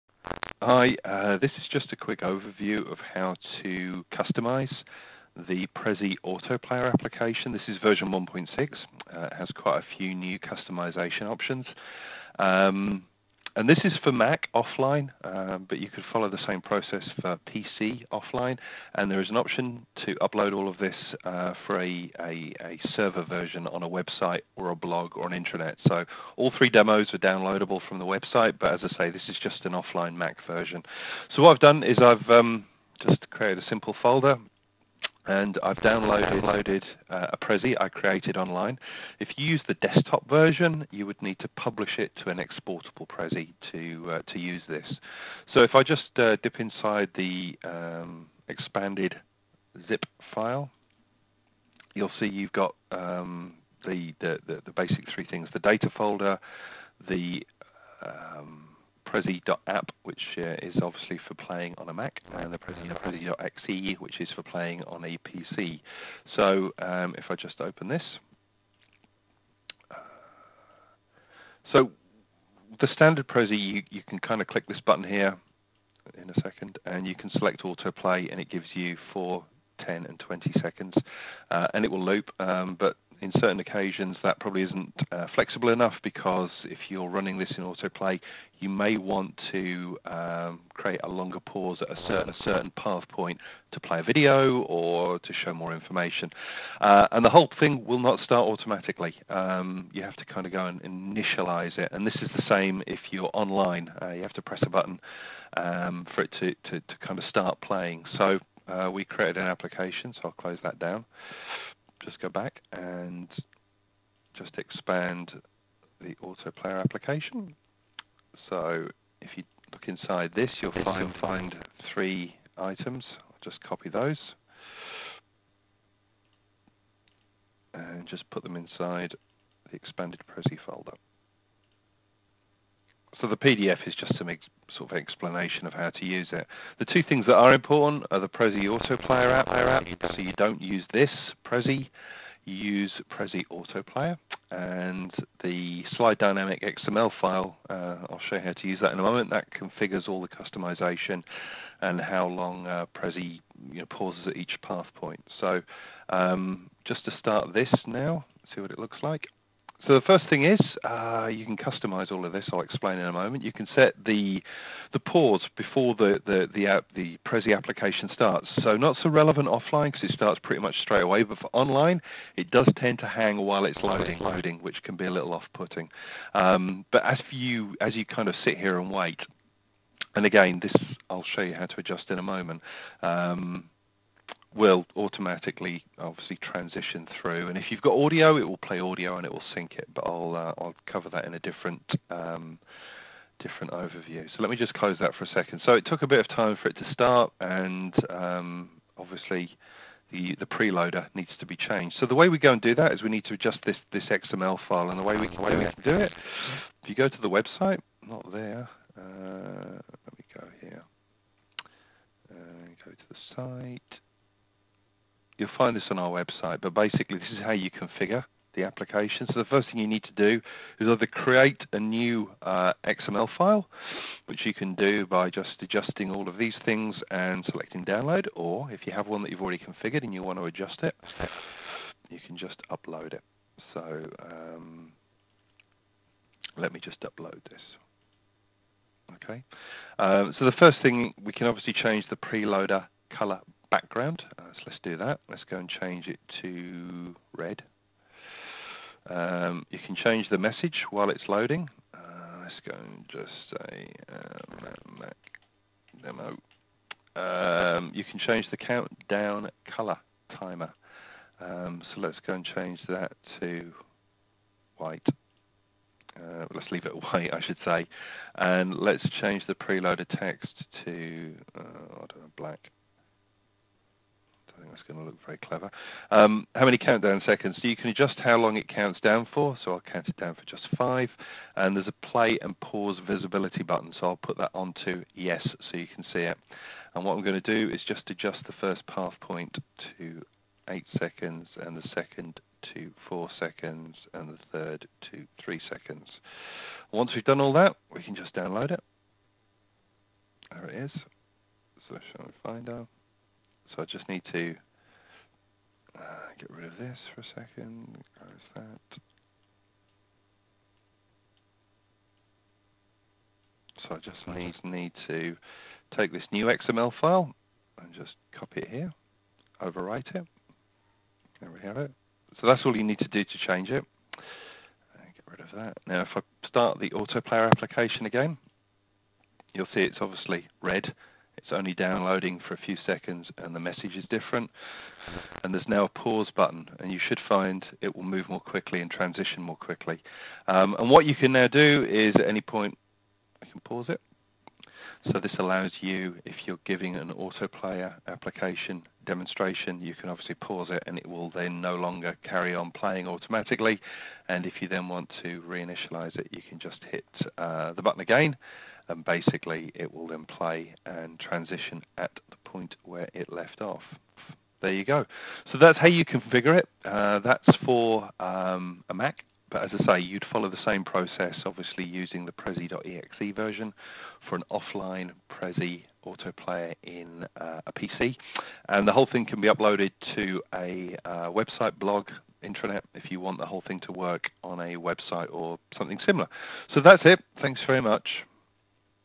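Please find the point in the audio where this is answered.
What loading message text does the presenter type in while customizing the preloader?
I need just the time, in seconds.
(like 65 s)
254 s.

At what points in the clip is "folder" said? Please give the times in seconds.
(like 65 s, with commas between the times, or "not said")
34 s, 55 s, 130 s.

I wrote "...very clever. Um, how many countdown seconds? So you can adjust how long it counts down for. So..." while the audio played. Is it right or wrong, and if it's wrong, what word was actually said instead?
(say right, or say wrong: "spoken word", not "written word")
right.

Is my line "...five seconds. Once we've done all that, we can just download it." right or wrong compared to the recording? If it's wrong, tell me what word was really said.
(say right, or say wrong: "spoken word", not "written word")
wrong: "three", not "five".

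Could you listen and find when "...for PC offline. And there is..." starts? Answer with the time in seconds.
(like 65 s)
17 s.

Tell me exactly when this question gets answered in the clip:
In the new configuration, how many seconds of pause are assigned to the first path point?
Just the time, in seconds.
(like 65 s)
290 s.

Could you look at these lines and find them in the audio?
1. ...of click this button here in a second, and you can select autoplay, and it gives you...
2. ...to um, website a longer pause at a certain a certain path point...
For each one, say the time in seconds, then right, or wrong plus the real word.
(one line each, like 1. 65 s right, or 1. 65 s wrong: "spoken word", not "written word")
1. 74 s right
2. 89 s wrong: "create", not "website".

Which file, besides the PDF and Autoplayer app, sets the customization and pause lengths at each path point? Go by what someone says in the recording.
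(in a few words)
Slide Dynamic XML file.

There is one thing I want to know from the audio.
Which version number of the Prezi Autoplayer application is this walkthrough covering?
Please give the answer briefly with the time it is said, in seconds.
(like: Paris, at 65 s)
1.6, at 8 s.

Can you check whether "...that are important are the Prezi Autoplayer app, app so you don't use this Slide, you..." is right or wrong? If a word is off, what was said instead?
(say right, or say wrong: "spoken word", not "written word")
wrong: "Prezi", not "Slide".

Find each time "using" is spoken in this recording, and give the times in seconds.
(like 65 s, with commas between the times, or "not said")
371 s.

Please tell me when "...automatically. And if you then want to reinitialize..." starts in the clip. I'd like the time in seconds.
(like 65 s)
353 s.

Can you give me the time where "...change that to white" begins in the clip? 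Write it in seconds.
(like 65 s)
262 s.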